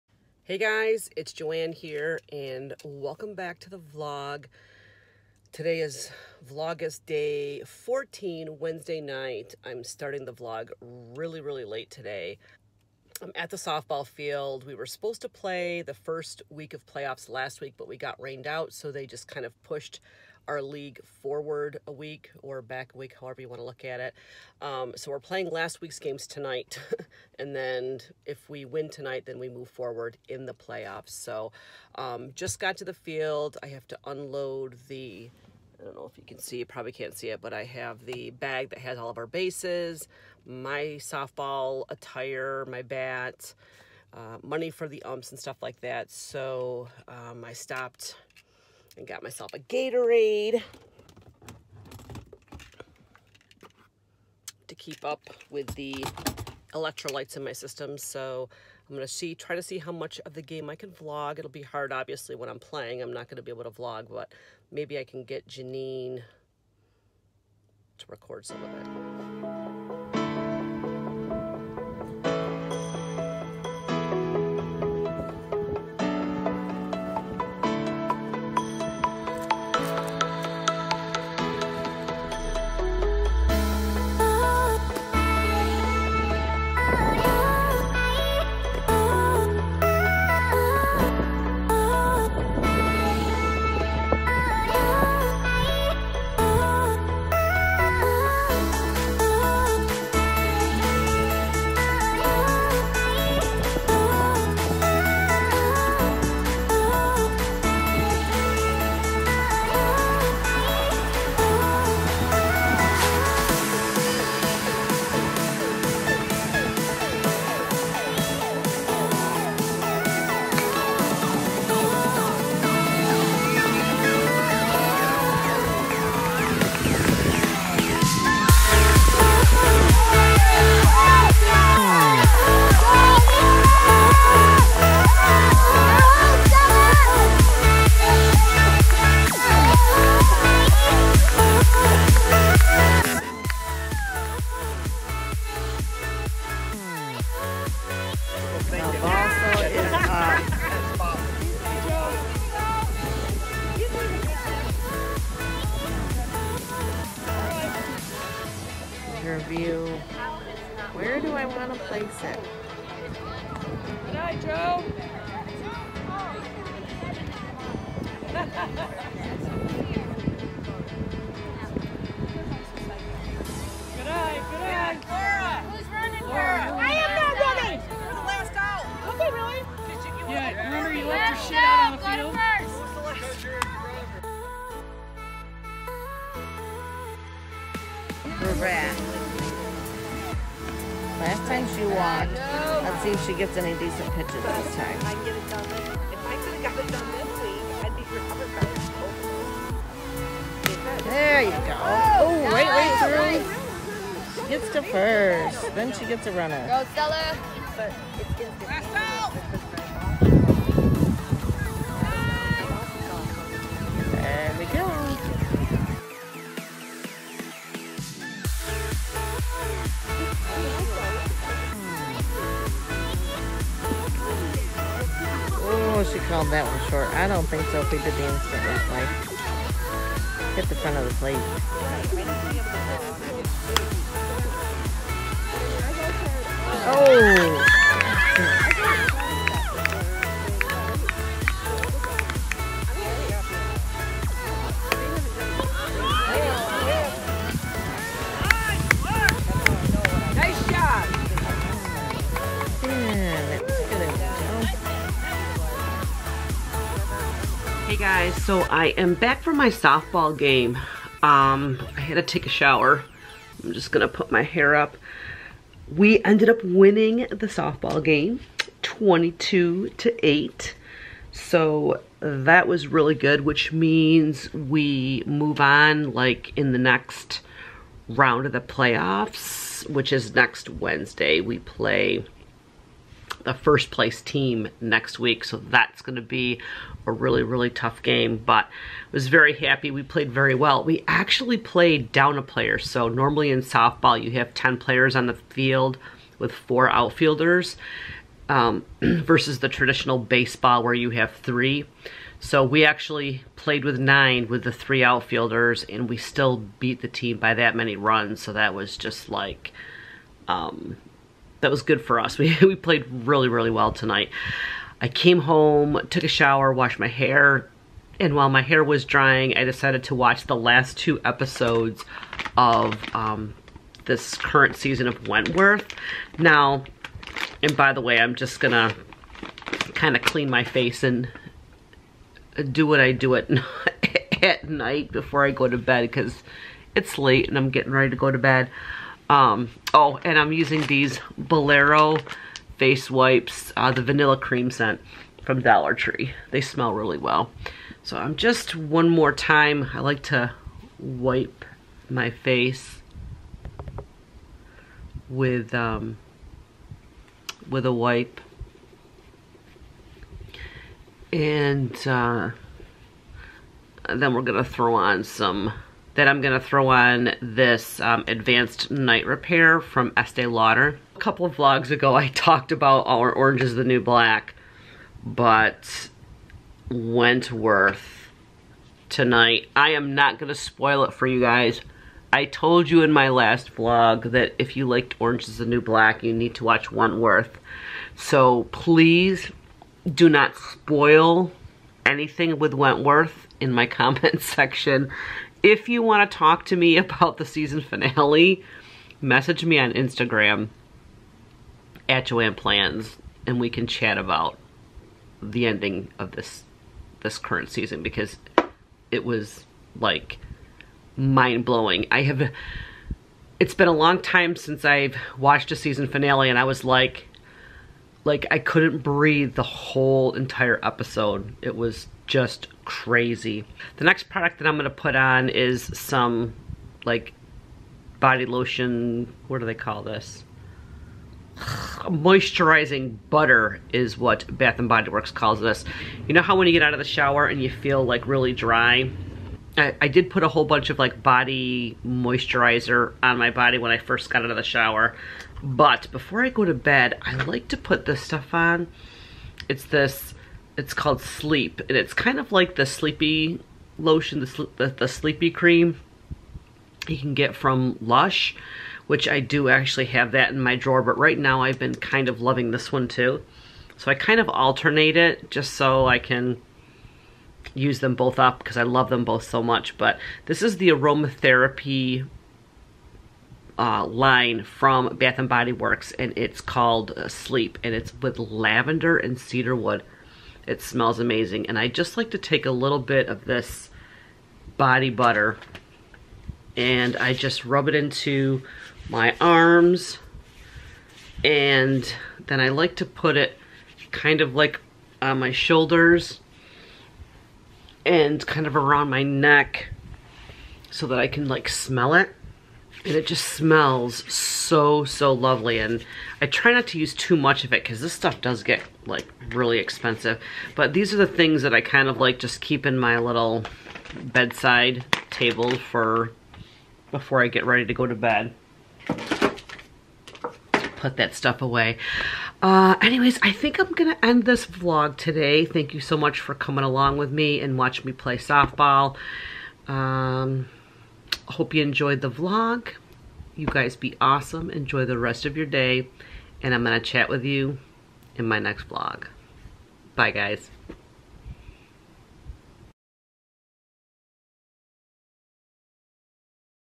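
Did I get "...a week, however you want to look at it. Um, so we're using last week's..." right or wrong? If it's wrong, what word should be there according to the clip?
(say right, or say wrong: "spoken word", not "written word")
wrong: "playing", not "using".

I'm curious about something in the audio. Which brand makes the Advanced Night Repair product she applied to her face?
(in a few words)
Estee Lauder.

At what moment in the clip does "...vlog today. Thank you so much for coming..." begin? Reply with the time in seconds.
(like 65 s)
524 s.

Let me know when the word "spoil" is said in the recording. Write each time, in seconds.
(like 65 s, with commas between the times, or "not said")
380 s, 390 s.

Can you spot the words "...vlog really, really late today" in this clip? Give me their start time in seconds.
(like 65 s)
10 s.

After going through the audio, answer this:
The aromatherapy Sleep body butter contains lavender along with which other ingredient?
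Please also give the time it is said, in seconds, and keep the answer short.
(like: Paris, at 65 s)
Cedarwood, at 479 s.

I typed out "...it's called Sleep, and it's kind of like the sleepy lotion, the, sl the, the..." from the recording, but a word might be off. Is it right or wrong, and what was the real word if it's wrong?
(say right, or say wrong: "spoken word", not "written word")
right.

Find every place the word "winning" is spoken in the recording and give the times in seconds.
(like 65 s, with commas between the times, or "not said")
266 s.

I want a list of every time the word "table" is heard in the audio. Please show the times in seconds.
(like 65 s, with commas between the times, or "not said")
515 s.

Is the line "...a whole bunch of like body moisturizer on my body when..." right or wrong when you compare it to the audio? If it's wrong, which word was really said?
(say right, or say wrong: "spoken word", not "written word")
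right.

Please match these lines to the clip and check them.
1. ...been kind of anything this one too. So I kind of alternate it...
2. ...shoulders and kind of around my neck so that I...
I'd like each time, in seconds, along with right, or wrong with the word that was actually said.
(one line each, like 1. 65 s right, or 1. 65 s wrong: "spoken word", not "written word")
1. 461 s wrong: "loving", not "anything"
2. 495 s right.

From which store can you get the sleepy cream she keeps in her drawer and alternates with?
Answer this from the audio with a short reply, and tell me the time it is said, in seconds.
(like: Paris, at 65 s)
Lush, at 458 s.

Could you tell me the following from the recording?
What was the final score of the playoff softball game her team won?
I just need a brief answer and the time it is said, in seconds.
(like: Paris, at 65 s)
22 to 8, at 268 s.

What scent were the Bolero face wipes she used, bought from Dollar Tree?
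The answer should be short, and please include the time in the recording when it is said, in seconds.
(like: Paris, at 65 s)
Vanilla cream, at 344 s.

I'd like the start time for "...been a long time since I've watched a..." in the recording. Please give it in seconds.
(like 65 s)
413 s.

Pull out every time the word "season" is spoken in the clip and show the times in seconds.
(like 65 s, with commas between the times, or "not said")
324 s, 397 s, 407 s, 415 s.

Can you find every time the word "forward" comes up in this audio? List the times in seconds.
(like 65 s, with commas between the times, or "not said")
21 s, 29 s.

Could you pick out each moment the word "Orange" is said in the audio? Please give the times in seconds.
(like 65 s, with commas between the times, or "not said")
373 s, 385 s.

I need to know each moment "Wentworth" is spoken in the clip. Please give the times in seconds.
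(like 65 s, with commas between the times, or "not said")
325 s, 376 s, 386 s, 392 s.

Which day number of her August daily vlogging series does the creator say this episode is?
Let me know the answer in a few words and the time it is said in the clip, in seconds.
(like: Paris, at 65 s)
14, at 6 s.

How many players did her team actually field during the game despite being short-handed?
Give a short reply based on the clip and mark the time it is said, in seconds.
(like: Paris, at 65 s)
9, at 303 s.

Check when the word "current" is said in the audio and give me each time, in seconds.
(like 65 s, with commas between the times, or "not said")
324 s, 407 s.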